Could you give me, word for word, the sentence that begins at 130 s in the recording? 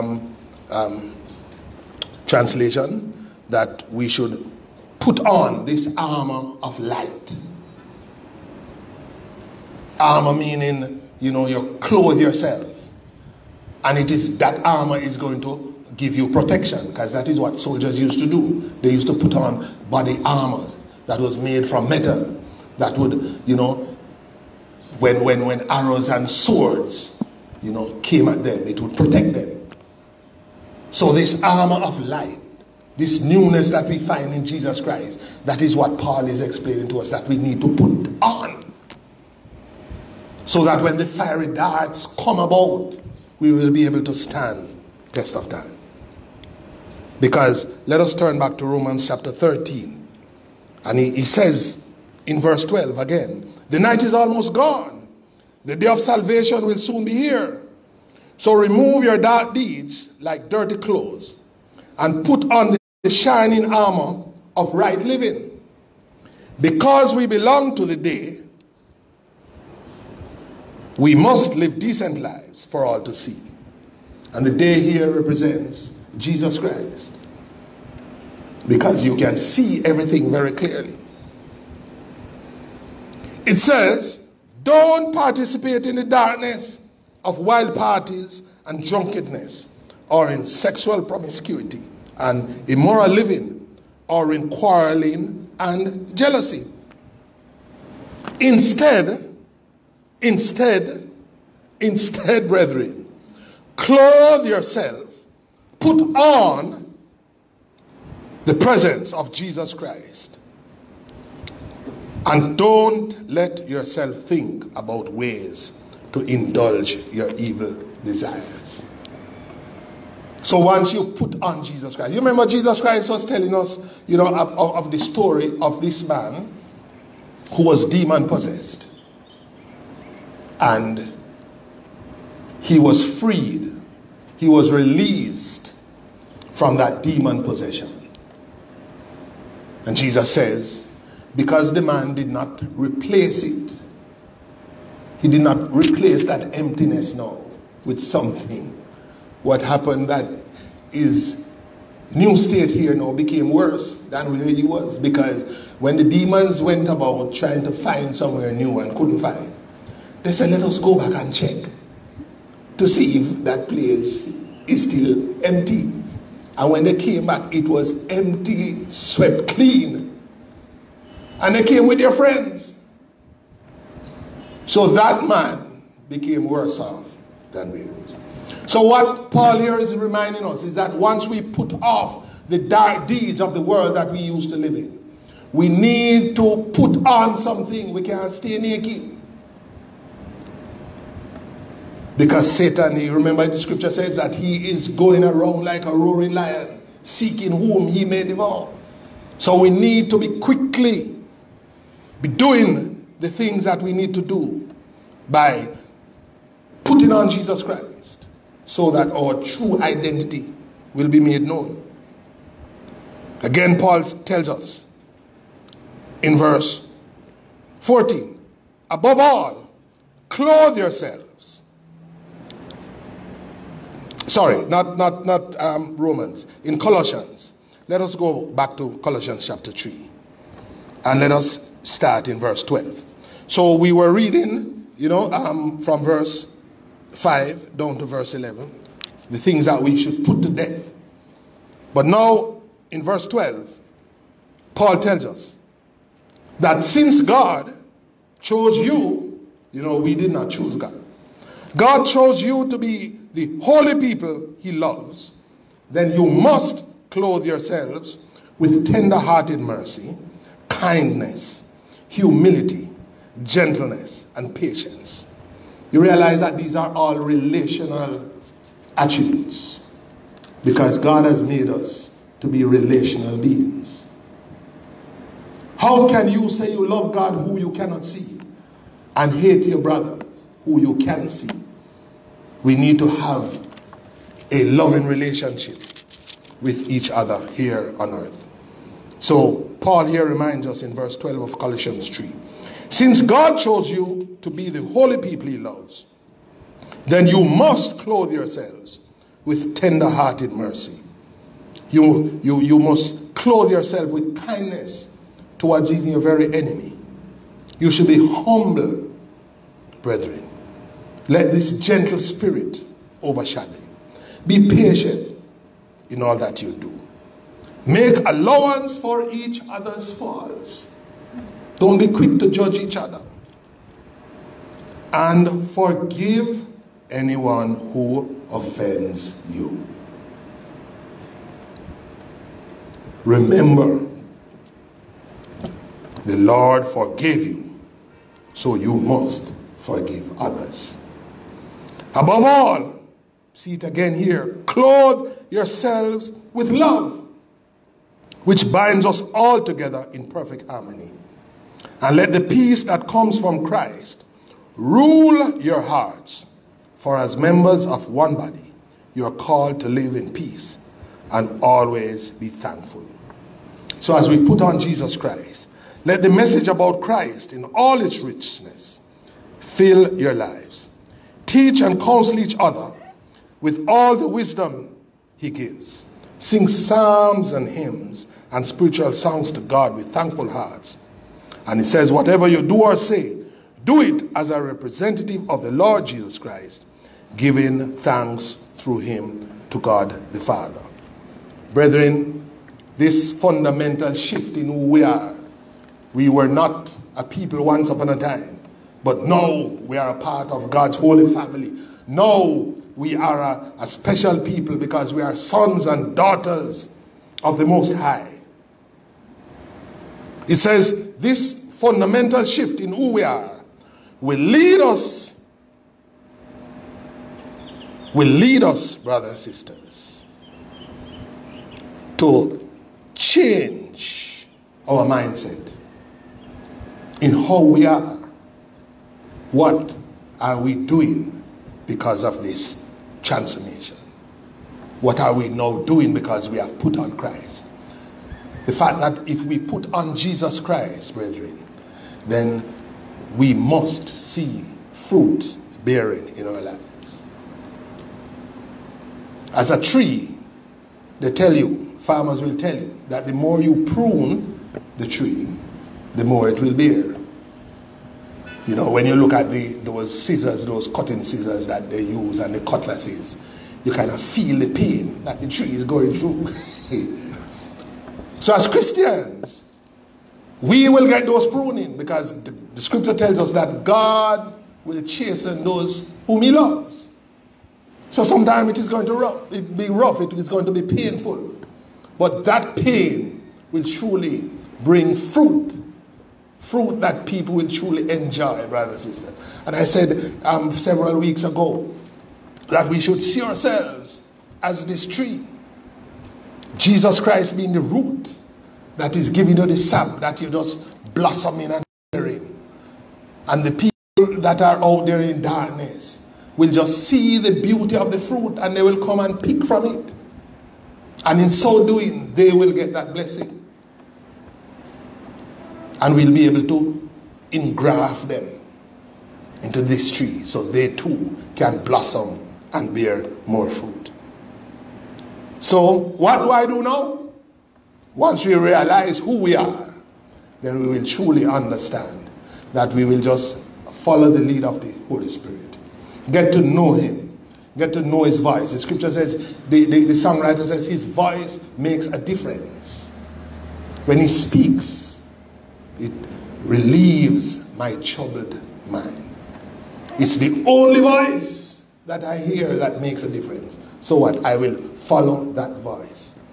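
And he was freed, he was released from that demon possession.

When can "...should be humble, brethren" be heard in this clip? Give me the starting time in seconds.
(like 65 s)
307 s.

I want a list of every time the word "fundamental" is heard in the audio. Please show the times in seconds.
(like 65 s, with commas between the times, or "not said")
393 s, 411 s.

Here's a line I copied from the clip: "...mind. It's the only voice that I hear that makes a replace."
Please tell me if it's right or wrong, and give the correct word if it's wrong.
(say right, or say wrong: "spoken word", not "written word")
wrong: "difference", not "replace".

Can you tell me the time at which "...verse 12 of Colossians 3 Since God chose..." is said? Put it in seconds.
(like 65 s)
290 s.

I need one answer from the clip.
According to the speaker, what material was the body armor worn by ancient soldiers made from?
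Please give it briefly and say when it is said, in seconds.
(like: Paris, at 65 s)
Metal, at 21 s.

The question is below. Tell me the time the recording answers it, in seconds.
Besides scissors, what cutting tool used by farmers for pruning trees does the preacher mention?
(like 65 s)
462 s.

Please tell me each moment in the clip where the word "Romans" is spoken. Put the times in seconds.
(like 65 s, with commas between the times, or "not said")
48 s, 225 s.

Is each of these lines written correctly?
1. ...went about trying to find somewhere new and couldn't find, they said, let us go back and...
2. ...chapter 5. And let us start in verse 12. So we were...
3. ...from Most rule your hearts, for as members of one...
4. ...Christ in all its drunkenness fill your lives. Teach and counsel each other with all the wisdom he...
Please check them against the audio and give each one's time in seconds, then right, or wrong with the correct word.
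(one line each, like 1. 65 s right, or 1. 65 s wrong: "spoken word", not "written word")
1. 156 s right
2. 229 s wrong: "3", not "5"
3. 353 s wrong: "Christ", not "Most"
4. 367 s wrong: "richness", not "drunkenness".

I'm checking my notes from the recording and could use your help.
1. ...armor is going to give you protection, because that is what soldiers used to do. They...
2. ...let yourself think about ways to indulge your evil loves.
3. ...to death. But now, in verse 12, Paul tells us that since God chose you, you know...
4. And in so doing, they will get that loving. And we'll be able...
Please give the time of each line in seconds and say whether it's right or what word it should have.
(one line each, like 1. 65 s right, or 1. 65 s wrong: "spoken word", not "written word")
1. 14 s right
2. 113 s wrong: "desires", not "loves"
3. 240 s right
4. 511 s wrong: "blessing", not "loving".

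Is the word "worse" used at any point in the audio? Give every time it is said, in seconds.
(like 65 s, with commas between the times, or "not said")
153 s, 176 s.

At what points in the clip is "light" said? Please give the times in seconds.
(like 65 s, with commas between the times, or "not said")
6 s, 32 s.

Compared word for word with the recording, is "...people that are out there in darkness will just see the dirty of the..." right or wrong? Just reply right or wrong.
wrong.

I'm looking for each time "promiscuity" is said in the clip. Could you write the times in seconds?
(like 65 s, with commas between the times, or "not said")
91 s.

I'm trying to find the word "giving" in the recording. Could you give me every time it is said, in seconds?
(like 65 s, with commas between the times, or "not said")
387 s, 499 s.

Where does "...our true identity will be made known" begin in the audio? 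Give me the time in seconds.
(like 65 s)
209 s.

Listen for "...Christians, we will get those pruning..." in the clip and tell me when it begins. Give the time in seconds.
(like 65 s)
468 s.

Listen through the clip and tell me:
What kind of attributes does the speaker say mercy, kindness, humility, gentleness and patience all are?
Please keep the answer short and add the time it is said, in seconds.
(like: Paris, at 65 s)
Relational attributes, at 267 s.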